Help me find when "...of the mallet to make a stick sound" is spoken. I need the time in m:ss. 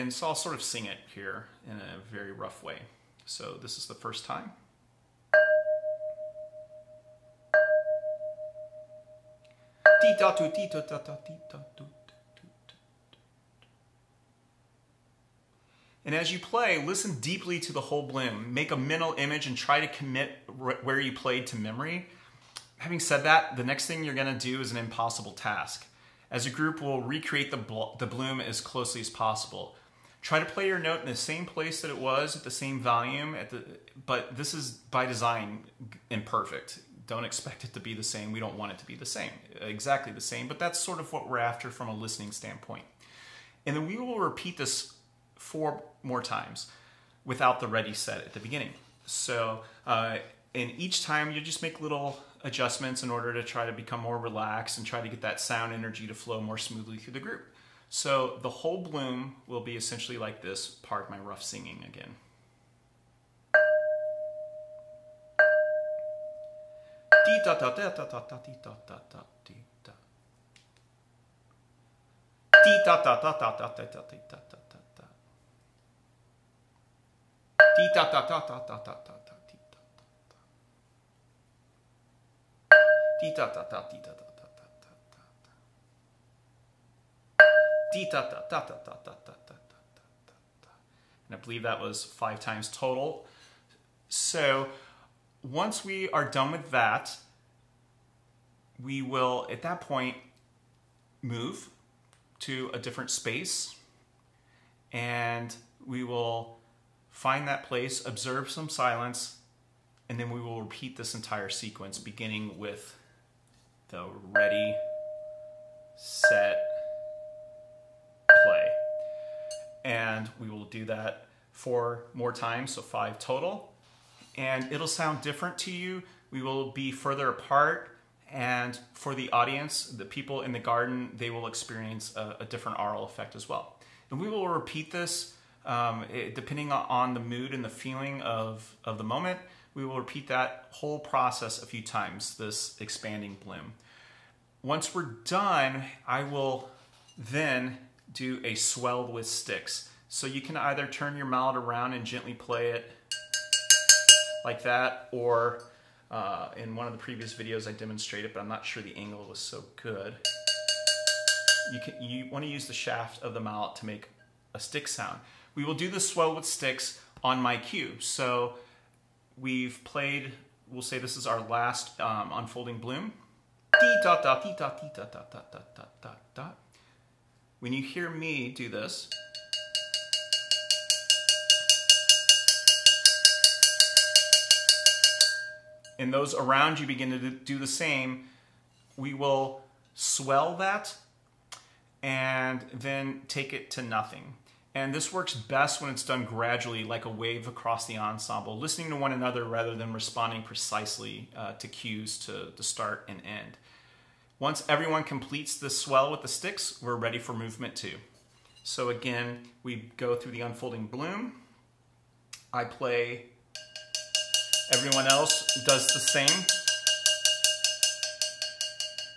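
2:43.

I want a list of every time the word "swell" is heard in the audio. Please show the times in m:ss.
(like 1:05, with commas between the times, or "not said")
2:28, 2:46, 3:09, 3:25.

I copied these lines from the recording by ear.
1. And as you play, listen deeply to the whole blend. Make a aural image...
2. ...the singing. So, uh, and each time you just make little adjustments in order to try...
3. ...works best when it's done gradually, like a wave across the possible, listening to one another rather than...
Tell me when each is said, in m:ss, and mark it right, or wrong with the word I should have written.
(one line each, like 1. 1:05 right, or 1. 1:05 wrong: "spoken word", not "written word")
1. 0:16 wrong: "mental", not "aural"
2. 0:48 wrong: "beginning", not "singing"
3. 3:15 wrong: "ensemble", not "possible".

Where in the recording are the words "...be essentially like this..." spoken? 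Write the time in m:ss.
0:59.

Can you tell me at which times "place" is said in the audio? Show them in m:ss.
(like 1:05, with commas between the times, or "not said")
0:31, 1:47.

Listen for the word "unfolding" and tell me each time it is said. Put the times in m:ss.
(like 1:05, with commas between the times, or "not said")
2:52, 3:30.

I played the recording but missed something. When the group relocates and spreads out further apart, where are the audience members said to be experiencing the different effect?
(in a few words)
in the garden.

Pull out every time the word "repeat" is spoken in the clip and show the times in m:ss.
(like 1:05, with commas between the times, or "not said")
0:44, 1:50, 2:14, 2:19.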